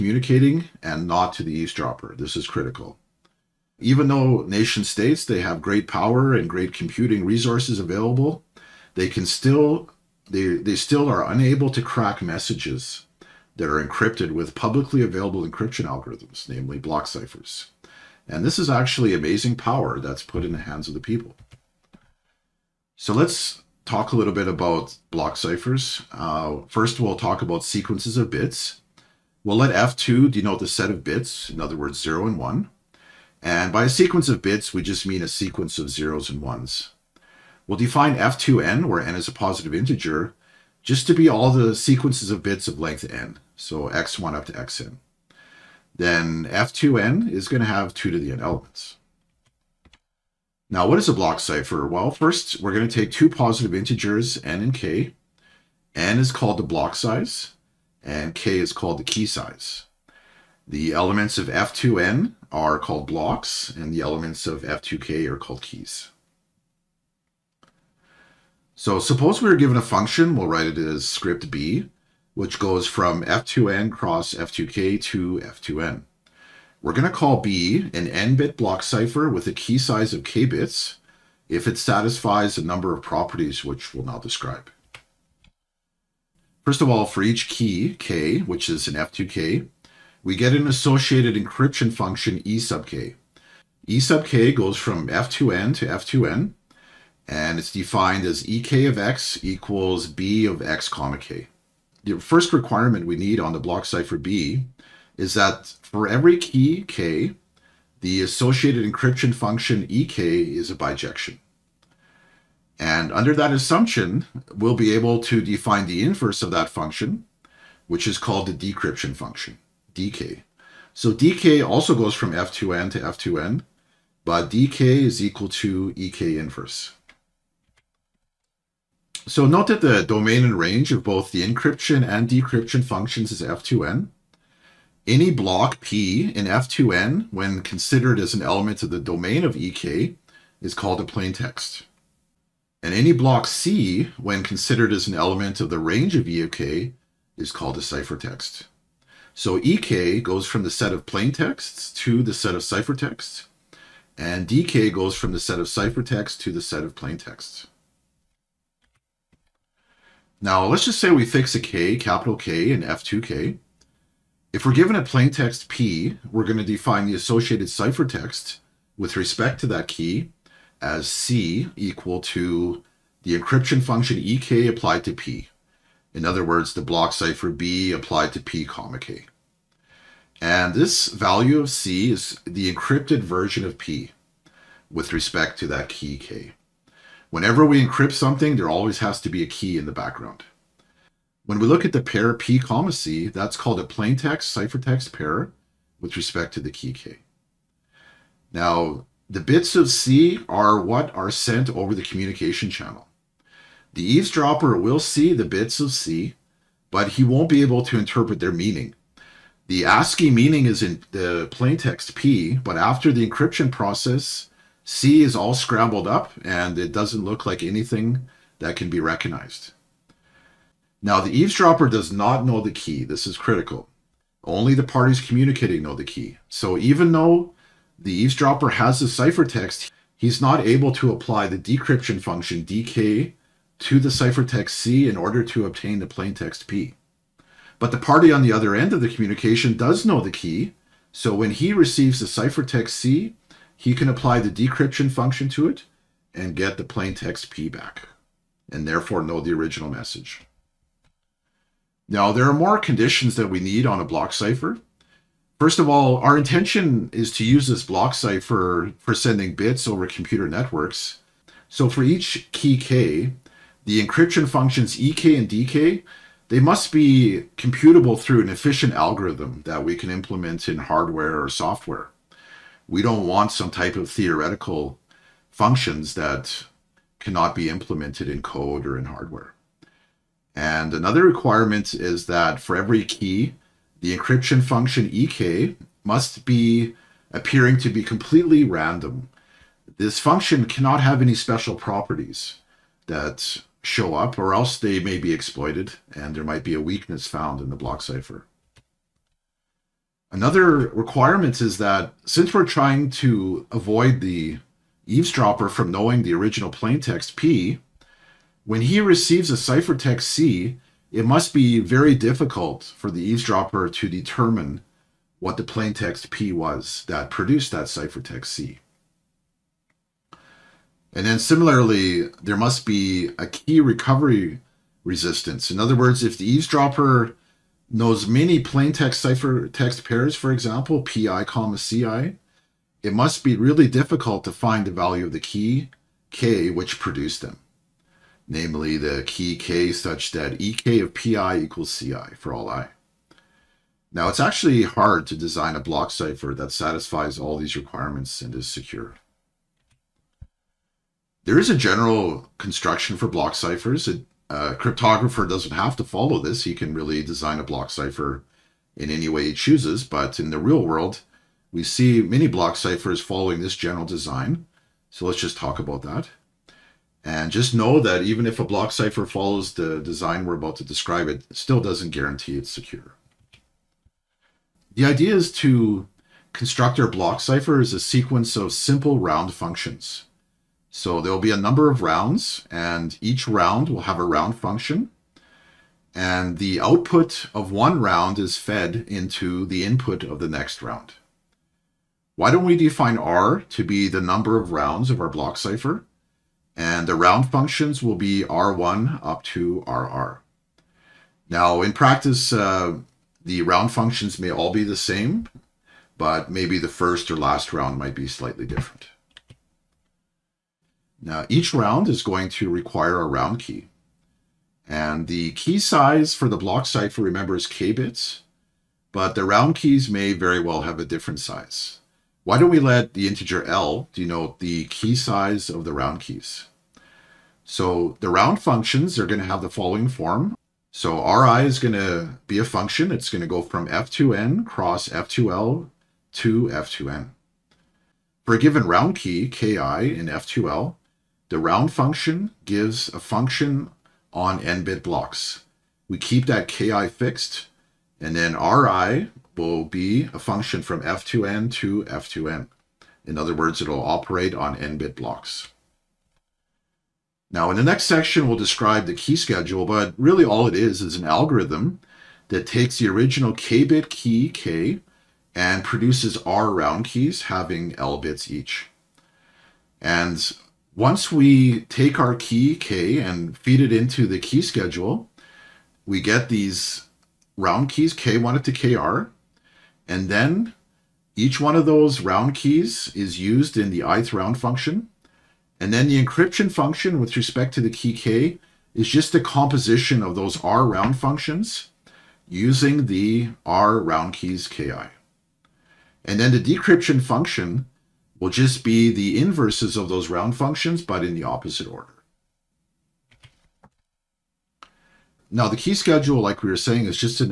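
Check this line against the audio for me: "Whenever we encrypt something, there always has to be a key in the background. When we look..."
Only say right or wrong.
right.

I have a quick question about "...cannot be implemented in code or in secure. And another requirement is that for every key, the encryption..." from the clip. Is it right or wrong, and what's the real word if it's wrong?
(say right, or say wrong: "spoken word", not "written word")
wrong: "hardware", not "secure".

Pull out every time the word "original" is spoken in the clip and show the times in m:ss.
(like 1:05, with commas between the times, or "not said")
4:09, 5:06, 7:43.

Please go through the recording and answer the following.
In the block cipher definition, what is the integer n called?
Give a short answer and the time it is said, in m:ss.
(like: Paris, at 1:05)
block size, at 0:56.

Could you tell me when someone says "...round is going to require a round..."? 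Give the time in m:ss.
6:51.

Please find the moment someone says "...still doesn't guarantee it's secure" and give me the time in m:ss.
6:11.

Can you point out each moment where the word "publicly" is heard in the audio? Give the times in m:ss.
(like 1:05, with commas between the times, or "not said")
0:14.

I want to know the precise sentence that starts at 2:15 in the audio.
Any block P in F2N, when considered as an element of the domain of EK, is called a plaintext.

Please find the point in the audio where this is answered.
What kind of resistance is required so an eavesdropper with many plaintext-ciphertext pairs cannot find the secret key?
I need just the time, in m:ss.
5:23.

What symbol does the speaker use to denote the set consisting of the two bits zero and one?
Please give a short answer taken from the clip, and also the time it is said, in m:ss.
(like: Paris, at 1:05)
F2, at 0:29.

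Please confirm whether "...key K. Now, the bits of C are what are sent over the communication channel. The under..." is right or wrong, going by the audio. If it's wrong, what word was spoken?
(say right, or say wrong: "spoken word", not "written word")
wrong: "eavesdropper", not "under".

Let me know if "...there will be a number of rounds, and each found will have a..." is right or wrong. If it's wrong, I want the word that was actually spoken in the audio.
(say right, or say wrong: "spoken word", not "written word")
wrong: "round", not "found".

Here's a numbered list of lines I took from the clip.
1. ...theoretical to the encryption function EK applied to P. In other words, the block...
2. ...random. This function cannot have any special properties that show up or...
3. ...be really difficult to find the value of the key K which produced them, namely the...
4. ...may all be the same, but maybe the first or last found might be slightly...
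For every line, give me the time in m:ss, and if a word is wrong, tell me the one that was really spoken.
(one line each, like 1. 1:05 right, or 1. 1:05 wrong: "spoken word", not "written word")
1. 2:51 wrong: "equal", not "theoretical"
2. 4:48 right
3. 5:33 right
4. 6:44 wrong: "round", not "found".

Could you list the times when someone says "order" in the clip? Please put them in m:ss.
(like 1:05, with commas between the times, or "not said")
3:55, 8:21.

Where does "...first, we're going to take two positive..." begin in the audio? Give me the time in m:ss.
0:52.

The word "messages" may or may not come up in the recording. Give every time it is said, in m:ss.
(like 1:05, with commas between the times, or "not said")
0:12, 4:09.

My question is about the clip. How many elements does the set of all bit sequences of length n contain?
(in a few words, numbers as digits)
2 to the n.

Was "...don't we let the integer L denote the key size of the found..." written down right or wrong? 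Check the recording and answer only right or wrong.
wrong.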